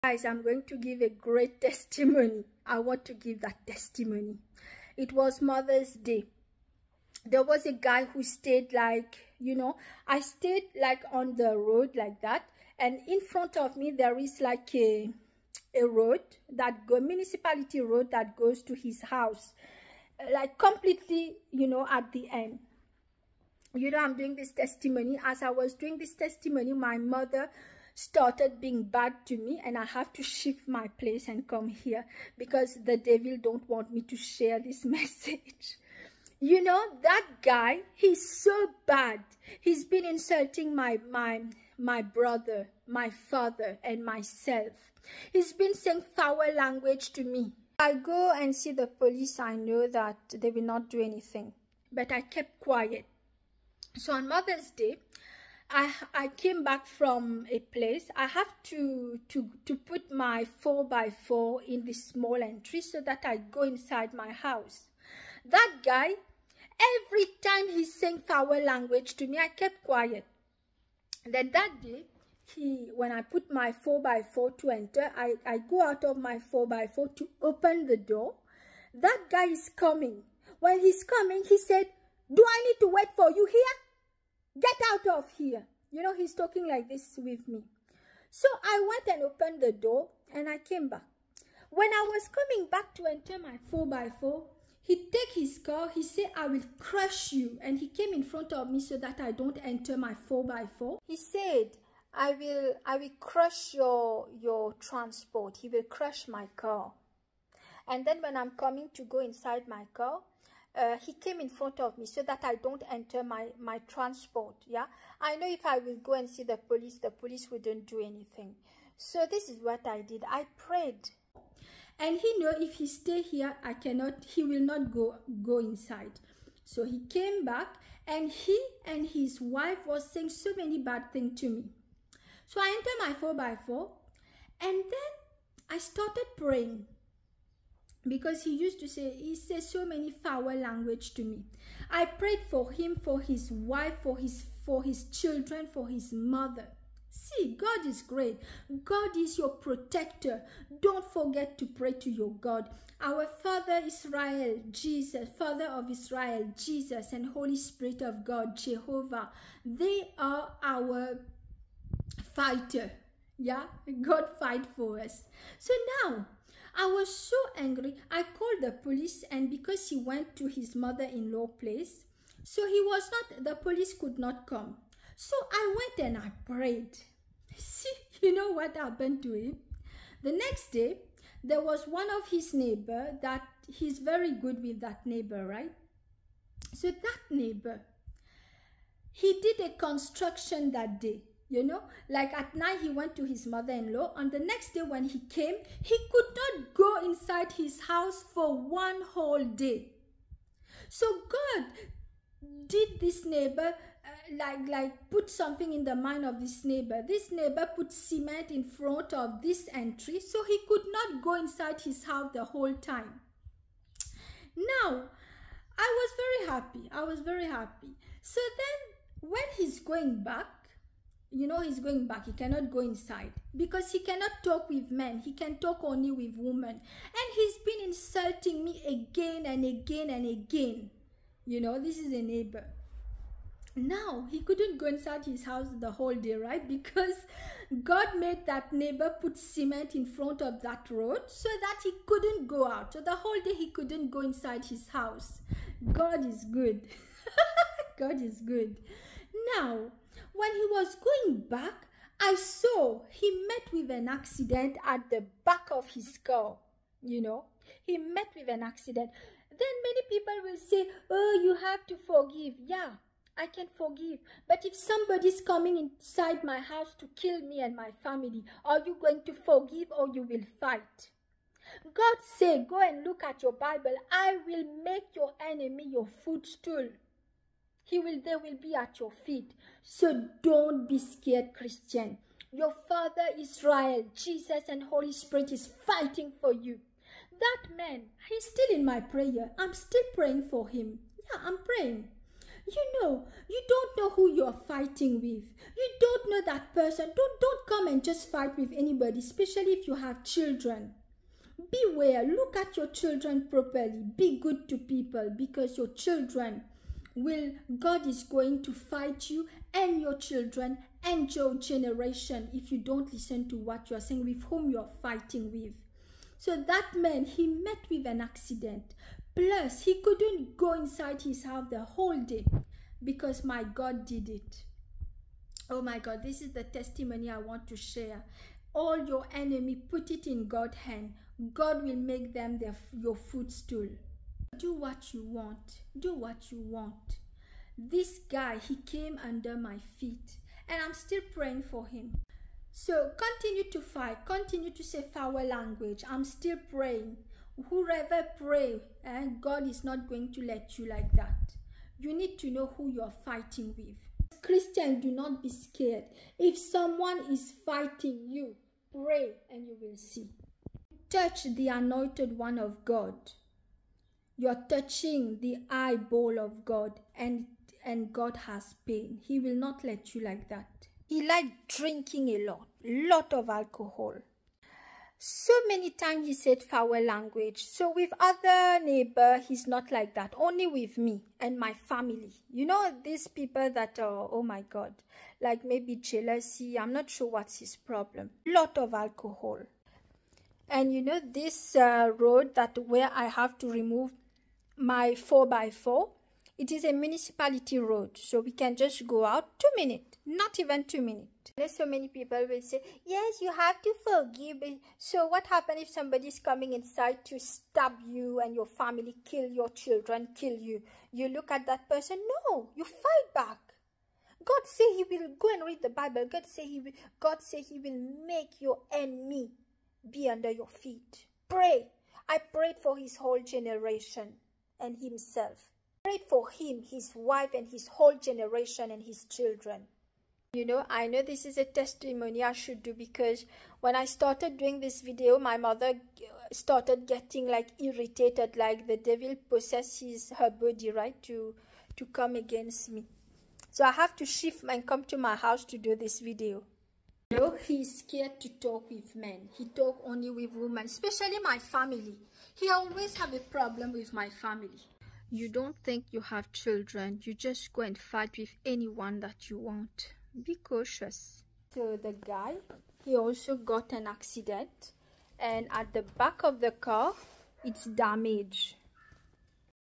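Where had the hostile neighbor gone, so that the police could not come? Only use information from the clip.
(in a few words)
his mother-in-law's place.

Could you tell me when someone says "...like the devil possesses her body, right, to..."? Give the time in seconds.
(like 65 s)
438 s.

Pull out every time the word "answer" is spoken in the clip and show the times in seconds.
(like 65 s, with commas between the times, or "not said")
not said.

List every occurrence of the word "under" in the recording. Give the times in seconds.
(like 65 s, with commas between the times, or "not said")
339 s, 420 s.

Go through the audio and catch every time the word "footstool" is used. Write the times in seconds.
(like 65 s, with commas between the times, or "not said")
276 s, 333 s.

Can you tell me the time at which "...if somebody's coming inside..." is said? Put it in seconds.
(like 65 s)
264 s.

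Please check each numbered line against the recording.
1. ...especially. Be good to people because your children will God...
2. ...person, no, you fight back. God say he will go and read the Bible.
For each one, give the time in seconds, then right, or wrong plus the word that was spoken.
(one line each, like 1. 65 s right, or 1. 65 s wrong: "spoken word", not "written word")
1. 303 s wrong: "properly", not "especially"
2. 411 s right.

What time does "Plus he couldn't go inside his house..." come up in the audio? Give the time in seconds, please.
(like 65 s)
319 s.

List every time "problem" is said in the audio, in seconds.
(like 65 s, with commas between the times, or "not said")
387 s, 453 s.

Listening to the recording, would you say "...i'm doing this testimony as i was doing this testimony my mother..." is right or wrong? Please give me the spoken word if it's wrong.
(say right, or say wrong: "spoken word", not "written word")
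right.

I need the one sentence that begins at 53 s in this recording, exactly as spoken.
So on Mother's Day, I, I came back from a place.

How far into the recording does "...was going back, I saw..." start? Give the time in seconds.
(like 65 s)
250 s.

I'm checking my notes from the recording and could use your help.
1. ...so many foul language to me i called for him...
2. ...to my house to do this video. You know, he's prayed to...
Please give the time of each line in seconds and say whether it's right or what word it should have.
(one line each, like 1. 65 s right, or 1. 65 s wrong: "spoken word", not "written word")
1. 139 s wrong: "prayed", not "called"
2. 445 s wrong: "scared", not "prayed".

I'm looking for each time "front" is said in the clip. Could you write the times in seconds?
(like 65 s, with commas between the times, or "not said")
13 s, 98 s, 111 s, 208 s, 240 s.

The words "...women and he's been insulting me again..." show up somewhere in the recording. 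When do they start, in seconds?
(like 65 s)
226 s.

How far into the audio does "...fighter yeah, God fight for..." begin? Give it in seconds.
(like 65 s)
162 s.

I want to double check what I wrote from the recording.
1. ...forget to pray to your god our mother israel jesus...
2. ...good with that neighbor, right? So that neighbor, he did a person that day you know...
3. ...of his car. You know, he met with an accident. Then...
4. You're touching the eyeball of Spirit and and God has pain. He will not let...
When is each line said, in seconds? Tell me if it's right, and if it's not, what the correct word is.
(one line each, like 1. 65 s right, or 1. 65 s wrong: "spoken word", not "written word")
1. 151 s wrong: "father", not "mother"
2. 184 s wrong: "construction", not "person"
3. 255 s right
4. 364 s wrong: "God", not "Spirit".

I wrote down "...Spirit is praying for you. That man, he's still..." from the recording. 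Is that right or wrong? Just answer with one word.
wrong.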